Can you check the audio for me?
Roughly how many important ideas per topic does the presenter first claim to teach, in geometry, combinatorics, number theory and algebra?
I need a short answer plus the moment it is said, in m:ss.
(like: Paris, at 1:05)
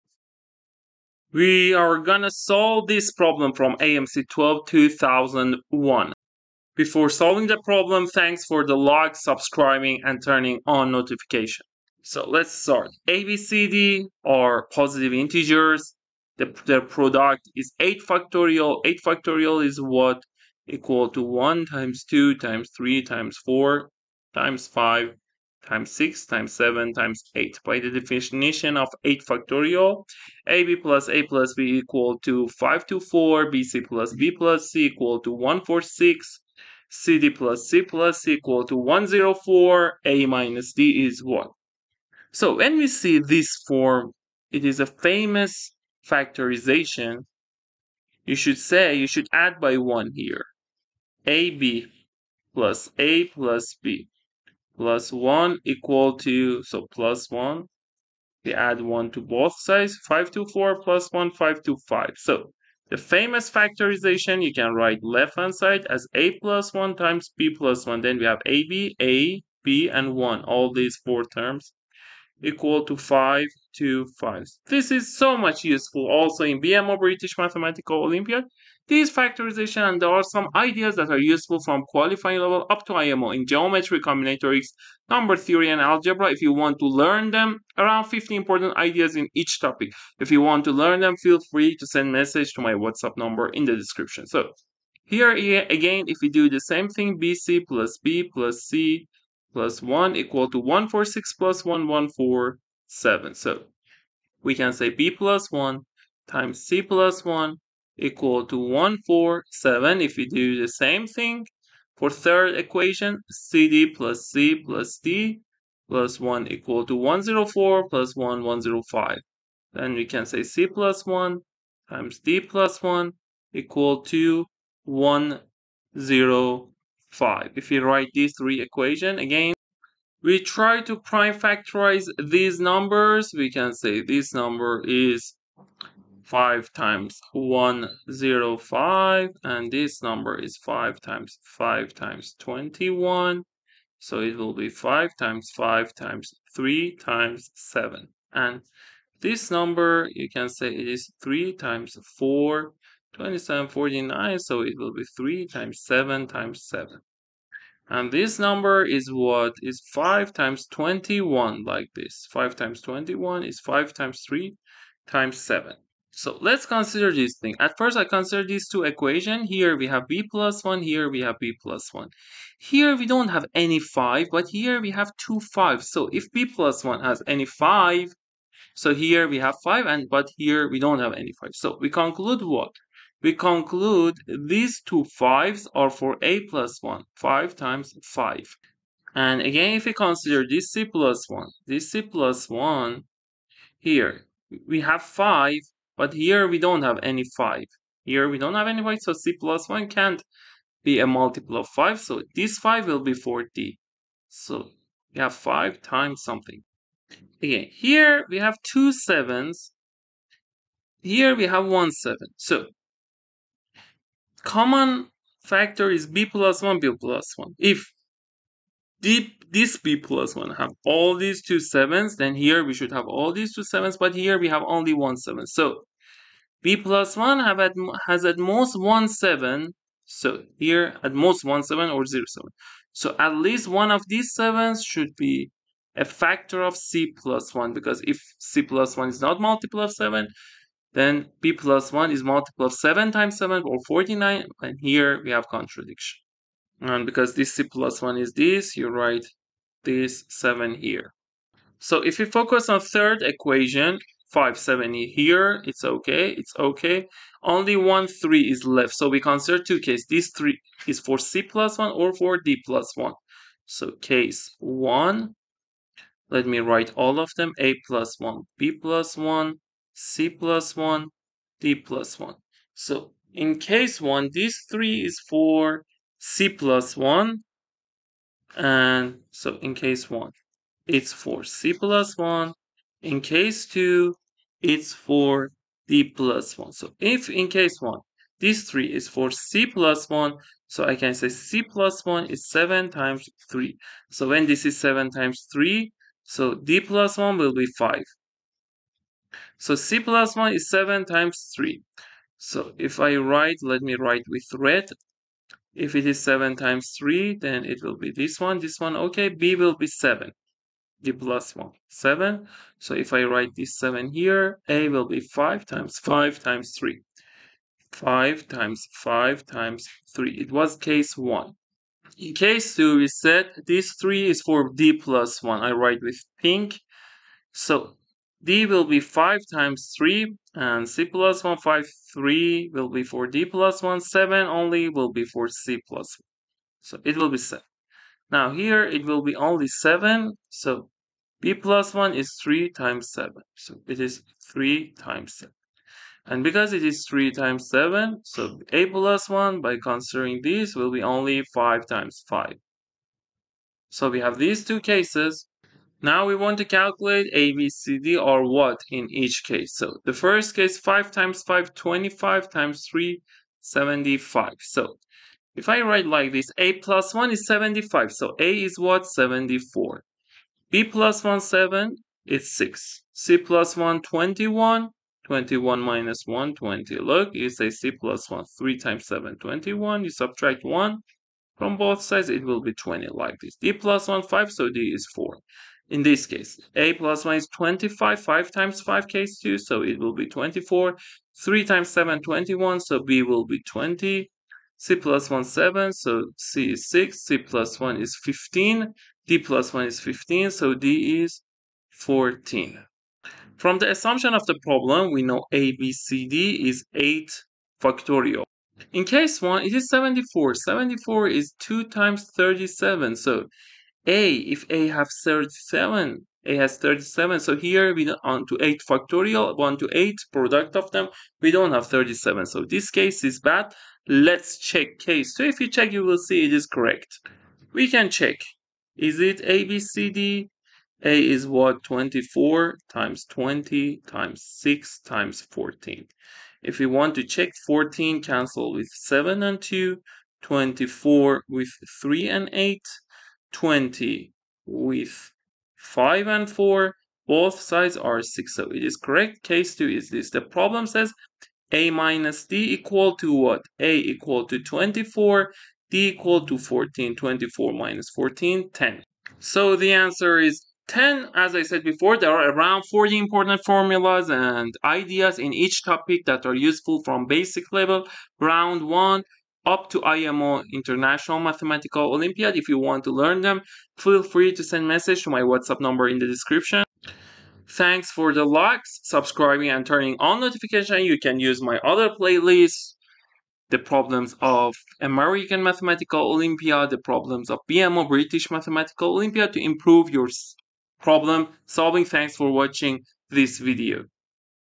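50, at 1:28.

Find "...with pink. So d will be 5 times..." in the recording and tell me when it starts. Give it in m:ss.
5:26.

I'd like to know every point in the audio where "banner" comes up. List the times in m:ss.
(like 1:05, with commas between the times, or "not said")
not said.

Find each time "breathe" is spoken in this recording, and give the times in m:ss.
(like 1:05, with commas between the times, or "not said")
not said.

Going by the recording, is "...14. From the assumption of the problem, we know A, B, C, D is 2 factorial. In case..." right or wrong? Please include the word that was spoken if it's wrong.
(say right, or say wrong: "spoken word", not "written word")
wrong: "8", not "2".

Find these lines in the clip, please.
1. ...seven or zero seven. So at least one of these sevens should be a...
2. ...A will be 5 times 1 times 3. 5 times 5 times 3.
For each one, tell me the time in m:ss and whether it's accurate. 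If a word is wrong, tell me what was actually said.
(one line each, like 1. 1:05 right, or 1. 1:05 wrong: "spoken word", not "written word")
1. 3:51 right
2. 5:14 wrong: "5", not "1".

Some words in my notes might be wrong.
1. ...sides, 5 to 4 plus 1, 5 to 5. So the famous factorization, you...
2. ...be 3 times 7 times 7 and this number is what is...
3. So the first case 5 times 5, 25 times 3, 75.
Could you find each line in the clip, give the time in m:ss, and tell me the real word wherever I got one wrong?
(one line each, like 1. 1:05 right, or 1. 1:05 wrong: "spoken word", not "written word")
1. 0:59 right
2. 2:34 right
3. 5:59 right.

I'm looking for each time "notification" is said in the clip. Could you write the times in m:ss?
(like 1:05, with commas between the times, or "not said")
0:10, 8:00.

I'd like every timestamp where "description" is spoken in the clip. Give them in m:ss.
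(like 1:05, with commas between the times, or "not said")
1:33, 7:56.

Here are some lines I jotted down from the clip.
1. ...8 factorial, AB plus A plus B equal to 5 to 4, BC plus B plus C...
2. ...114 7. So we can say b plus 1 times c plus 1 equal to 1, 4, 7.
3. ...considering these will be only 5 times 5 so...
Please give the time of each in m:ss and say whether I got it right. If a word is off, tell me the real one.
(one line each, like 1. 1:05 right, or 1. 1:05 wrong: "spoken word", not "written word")
1. 0:29 right
2. 1:41 right
3. 5:49 right.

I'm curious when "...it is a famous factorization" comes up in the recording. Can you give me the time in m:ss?
0:44.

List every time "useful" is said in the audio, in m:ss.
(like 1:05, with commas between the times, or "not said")
1:15, 1:21, 7:46.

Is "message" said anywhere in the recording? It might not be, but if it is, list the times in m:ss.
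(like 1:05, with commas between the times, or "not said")
1:32, 7:54.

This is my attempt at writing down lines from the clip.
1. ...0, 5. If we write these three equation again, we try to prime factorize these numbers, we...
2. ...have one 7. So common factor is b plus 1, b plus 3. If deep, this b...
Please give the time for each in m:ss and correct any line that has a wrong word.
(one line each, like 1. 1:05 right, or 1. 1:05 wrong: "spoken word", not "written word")
1. 2:05 right
2. 3:31 wrong: "1", not "3".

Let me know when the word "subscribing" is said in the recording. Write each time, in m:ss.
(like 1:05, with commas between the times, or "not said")
0:09, 7:59.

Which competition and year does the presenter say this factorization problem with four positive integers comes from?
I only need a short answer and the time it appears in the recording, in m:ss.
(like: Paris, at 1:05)
AMC 12 2001, at 0:03.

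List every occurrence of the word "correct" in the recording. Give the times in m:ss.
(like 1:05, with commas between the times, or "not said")
7:06, 7:28.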